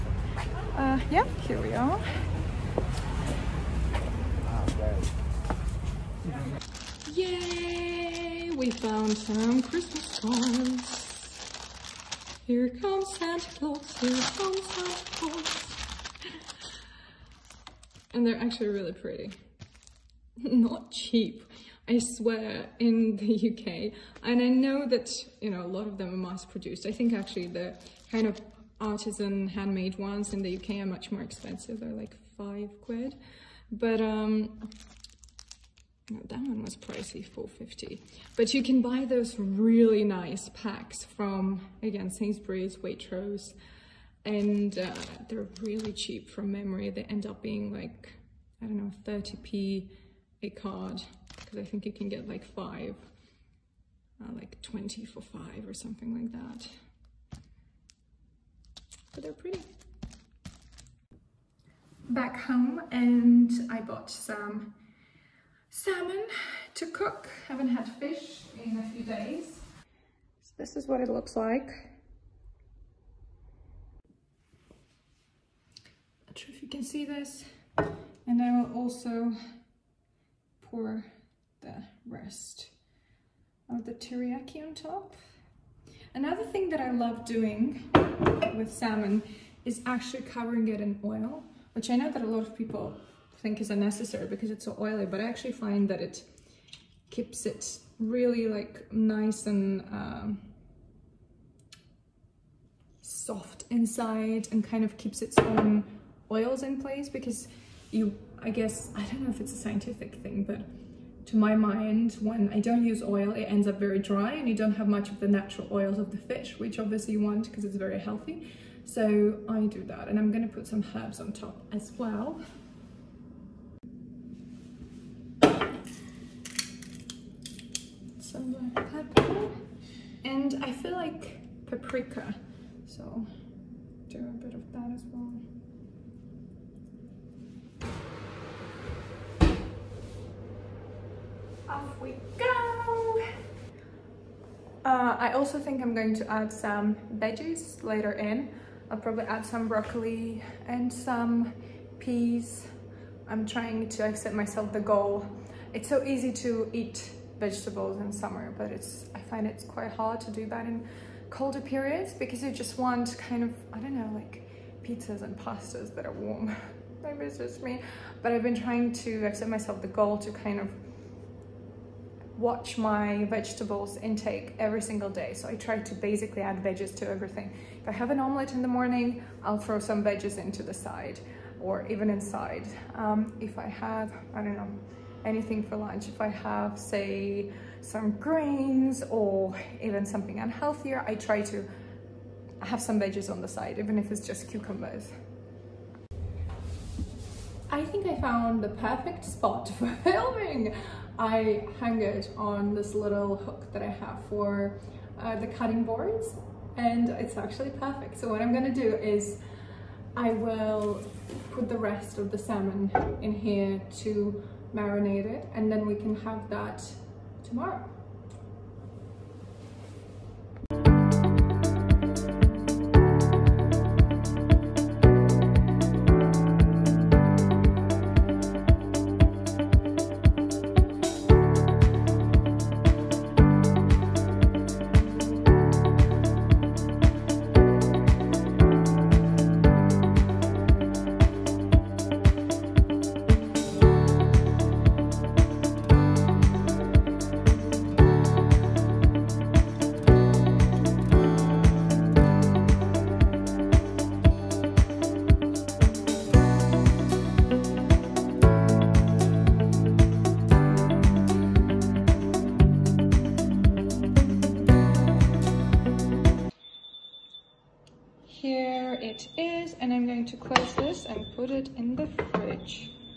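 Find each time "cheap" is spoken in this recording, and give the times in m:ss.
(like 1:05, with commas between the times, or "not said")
0:20, 0:45.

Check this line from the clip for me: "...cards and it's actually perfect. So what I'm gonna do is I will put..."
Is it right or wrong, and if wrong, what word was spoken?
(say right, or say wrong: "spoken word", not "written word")
wrong: "boards", not "cards".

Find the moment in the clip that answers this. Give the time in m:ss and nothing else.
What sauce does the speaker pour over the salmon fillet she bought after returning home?
1:23.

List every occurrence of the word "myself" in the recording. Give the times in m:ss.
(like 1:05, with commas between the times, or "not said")
2:34, 2:49.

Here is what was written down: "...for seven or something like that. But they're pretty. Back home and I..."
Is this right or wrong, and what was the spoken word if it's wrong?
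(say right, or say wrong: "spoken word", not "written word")
wrong: "five", not "seven".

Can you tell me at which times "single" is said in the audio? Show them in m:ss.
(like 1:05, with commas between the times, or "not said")
2:54.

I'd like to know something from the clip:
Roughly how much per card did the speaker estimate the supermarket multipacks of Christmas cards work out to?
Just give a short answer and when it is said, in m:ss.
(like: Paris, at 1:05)
30p, at 0:49.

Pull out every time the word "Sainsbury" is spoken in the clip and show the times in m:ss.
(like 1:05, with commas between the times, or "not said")
0:42.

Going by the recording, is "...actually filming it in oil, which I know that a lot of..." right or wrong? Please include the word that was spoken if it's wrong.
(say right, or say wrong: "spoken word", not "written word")
wrong: "covering", not "filming".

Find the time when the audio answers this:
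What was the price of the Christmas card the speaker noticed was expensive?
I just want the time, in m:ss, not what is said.
0:37.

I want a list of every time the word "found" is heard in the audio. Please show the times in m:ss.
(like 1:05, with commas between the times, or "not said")
0:08, 3:18.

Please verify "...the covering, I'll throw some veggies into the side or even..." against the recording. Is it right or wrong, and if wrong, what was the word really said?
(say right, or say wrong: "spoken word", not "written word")
wrong: "morning", not "covering".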